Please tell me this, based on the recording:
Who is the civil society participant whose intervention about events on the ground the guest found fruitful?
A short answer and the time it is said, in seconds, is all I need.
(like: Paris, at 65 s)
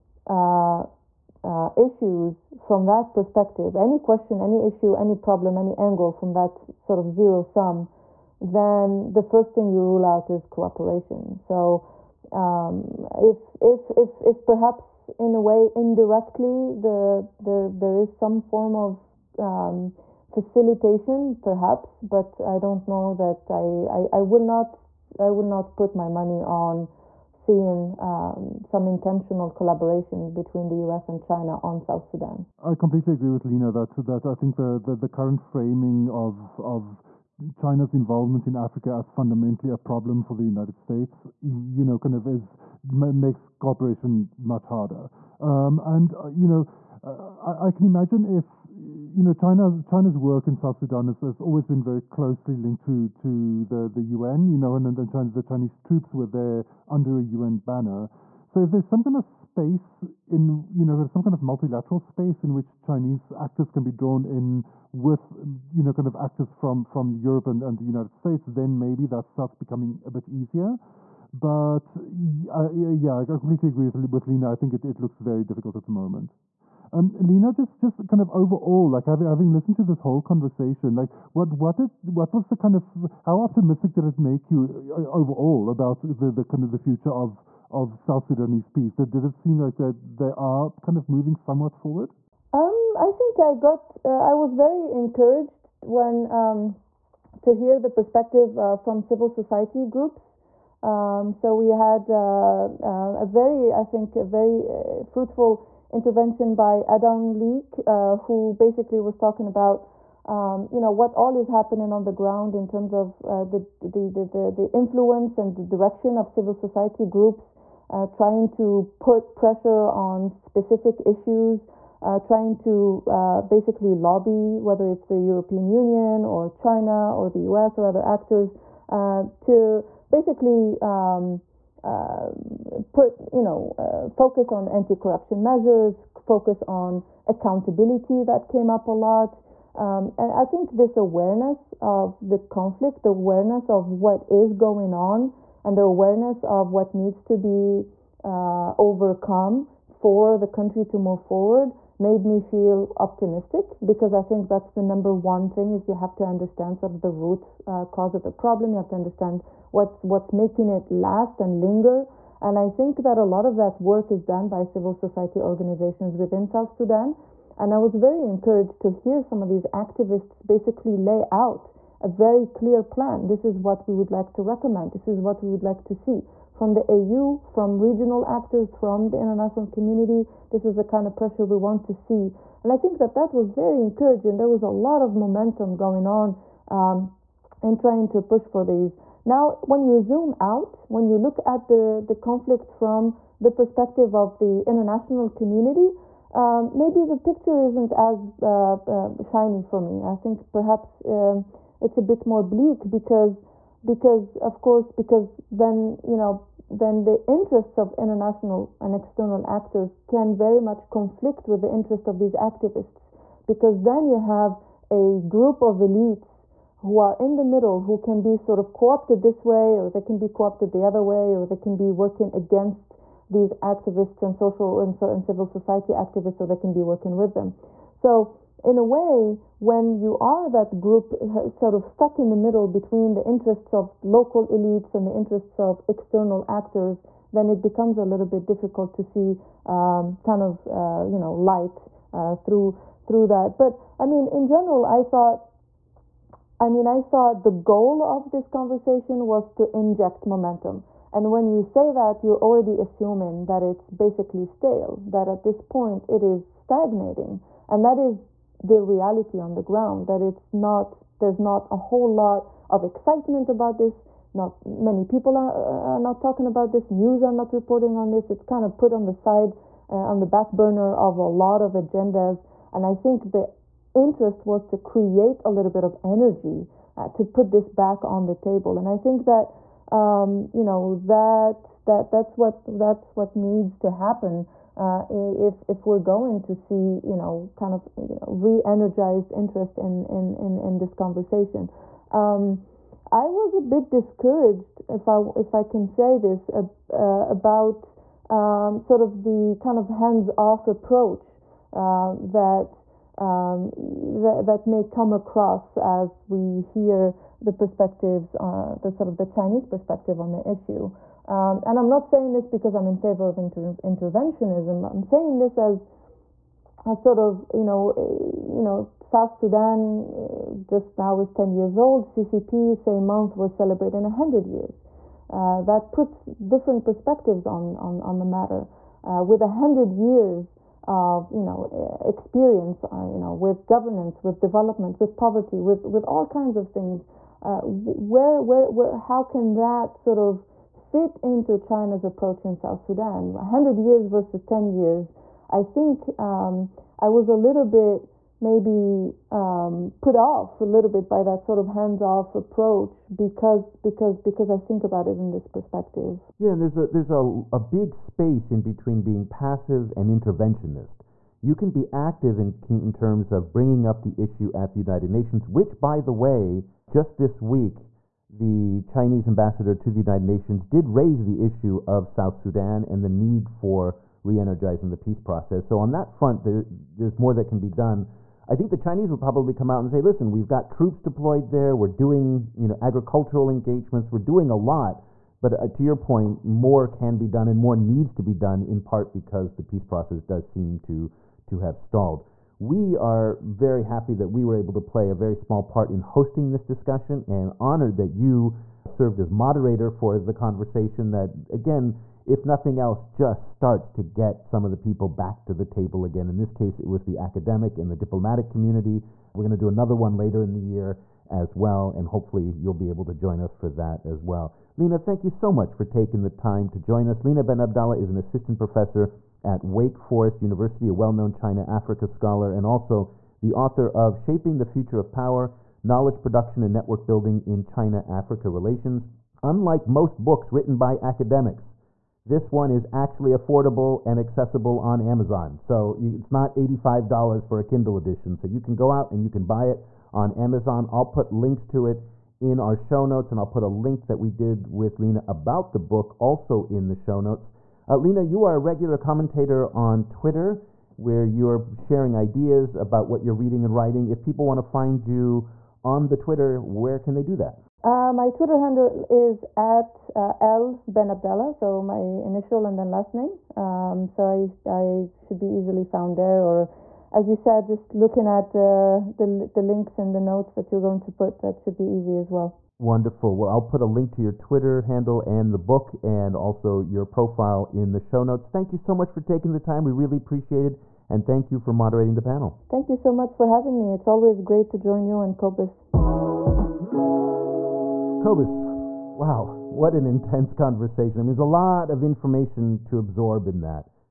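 Adam Leek, at 106 s.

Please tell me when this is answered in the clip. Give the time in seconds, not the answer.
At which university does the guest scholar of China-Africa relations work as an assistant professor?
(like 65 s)
419 s.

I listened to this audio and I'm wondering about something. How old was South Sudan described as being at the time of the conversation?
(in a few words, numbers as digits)
10 years.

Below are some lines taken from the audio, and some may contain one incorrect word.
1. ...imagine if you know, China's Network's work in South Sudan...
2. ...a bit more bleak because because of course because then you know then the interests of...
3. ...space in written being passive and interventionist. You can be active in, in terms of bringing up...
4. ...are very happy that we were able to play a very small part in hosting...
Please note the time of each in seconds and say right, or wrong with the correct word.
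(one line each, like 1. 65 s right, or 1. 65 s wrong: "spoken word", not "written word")
1. 47 s wrong: "China", not "Network"
2. 201 s right
3. 357 s wrong: "between", not "written"
4. 392 s right.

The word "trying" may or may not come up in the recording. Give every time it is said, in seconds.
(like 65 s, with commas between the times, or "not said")
118 s, 122 s, 187 s.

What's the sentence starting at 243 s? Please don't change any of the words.
But I mean, in general, I thought.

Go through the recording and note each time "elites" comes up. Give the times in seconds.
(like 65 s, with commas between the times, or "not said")
215 s, 234 s.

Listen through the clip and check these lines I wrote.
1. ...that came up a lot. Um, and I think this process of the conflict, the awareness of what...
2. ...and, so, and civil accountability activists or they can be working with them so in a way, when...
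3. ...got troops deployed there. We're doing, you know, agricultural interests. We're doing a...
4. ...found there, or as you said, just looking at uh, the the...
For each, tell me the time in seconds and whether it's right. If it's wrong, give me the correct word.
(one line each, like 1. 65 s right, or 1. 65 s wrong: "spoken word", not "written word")
1. 138 s wrong: "awareness", not "process"
2. 224 s wrong: "society", not "accountability"
3. 380 s wrong: "engagements", not "interests"
4. 465 s right.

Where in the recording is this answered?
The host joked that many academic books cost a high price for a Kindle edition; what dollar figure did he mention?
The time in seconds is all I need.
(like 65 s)
436 s.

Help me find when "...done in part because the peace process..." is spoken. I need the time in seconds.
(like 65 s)
388 s.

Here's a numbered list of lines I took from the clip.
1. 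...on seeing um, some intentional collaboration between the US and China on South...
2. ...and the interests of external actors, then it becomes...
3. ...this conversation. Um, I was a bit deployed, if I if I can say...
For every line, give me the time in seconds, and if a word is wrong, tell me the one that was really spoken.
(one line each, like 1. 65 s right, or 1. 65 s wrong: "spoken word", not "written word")
1. 26 s right
2. 234 s right
3. 290 s wrong: "discouraged", not "deployed".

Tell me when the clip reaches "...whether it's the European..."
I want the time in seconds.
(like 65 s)
124 s.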